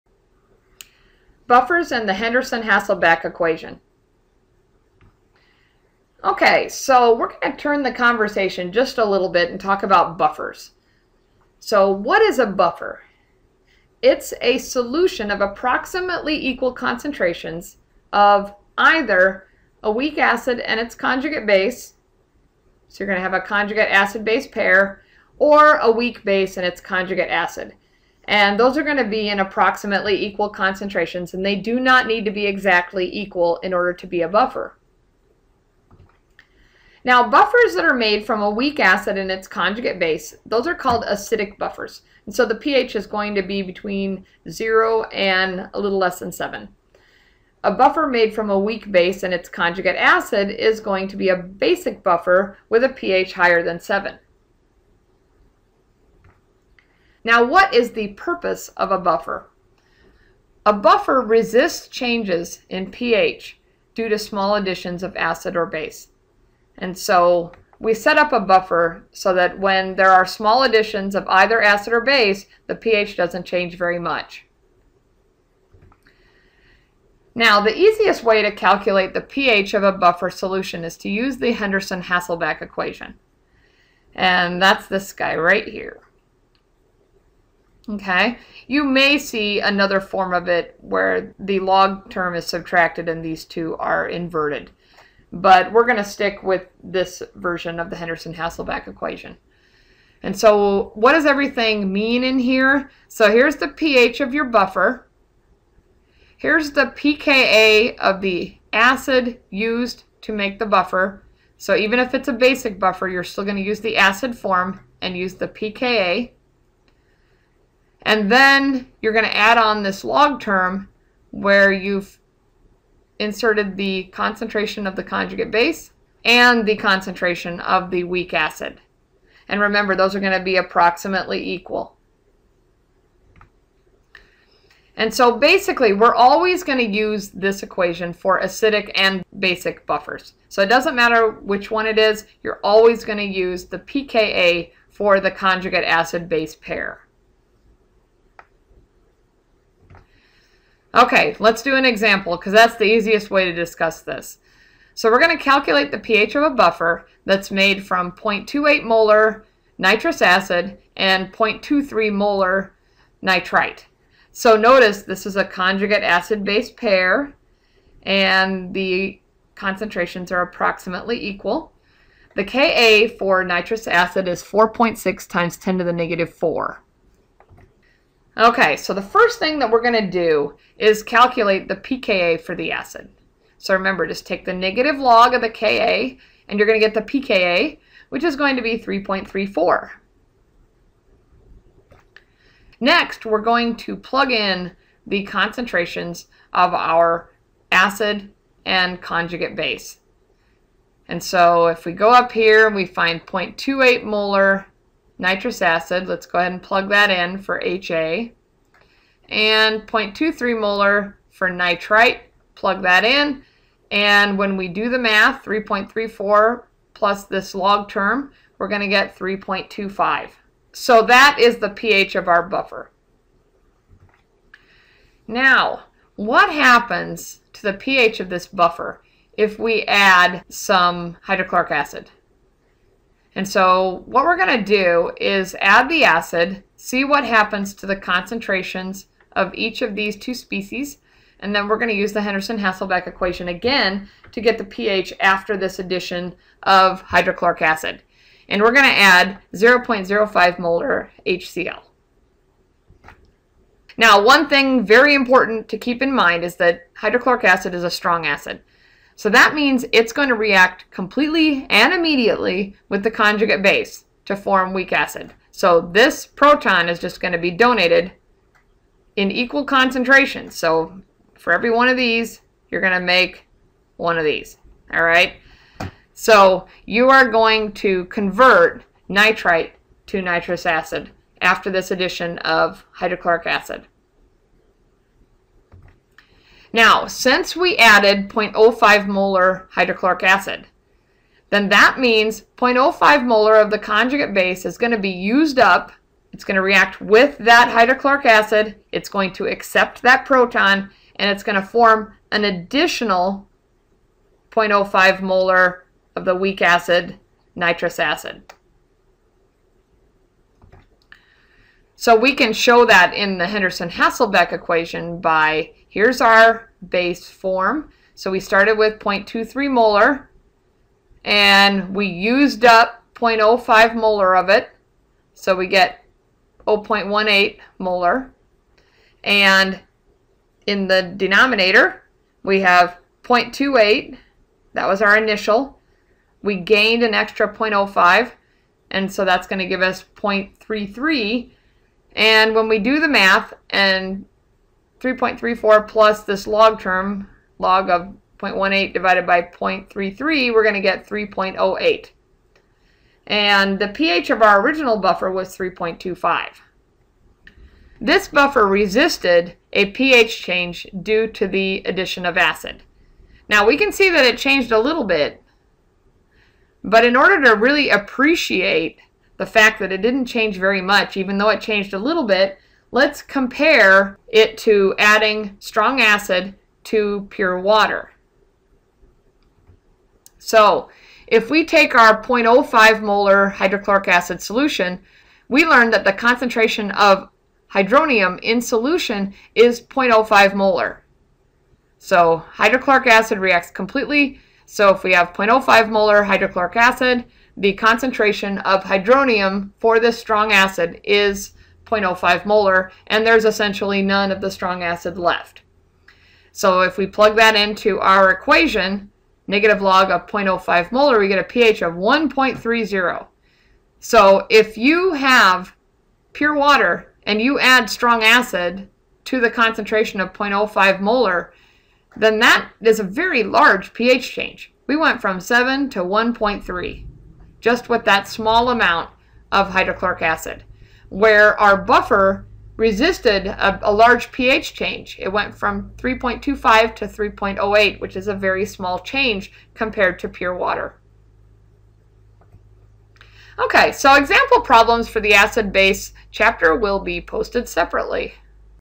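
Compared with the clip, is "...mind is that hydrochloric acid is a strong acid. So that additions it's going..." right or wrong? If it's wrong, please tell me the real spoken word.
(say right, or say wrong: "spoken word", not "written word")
wrong: "means", not "additions".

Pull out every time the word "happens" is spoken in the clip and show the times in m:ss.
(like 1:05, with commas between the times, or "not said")
3:46, 3:57.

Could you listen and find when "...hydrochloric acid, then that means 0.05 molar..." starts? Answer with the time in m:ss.
4:49.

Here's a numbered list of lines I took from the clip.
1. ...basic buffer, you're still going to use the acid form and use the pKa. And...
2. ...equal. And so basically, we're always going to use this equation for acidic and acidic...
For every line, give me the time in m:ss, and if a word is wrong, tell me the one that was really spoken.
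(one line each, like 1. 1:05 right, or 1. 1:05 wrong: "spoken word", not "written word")
1. 1:52 right
2. 2:11 wrong: "basic", not "acidic".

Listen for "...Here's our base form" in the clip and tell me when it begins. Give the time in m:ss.
5:15.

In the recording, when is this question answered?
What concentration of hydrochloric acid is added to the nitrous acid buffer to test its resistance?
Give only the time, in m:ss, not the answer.
4:09.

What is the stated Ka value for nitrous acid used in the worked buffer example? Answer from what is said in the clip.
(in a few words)
4.6 x 10^-4.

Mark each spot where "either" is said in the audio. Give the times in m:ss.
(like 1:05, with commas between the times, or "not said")
0:18, 1:11.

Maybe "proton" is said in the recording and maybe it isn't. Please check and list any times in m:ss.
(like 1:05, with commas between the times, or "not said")
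4:26, 5:00.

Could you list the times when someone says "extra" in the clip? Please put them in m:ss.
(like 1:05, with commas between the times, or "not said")
5:37.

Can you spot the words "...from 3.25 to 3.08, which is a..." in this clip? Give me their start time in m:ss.
7:15.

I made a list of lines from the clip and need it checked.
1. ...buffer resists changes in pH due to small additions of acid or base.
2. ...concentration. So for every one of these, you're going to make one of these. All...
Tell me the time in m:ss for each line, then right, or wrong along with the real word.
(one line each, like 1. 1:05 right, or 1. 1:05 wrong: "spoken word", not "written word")
1. 1:00 right
2. 4:29 right.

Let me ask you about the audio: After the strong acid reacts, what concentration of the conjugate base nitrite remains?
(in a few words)
0.18 molar.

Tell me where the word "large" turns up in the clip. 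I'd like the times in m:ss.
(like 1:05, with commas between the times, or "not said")
7:03, 7:13.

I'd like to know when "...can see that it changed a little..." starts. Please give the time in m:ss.
6:03.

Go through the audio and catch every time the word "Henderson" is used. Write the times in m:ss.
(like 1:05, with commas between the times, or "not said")
0:02, 1:21, 1:37, 4:02, 5:13.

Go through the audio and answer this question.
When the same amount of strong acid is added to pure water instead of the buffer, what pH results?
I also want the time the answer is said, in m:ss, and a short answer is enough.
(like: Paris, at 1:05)
1.30, at 6:51.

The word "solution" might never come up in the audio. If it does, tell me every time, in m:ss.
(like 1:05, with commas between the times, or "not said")
0:14, 1:20, 6:24, 6:28.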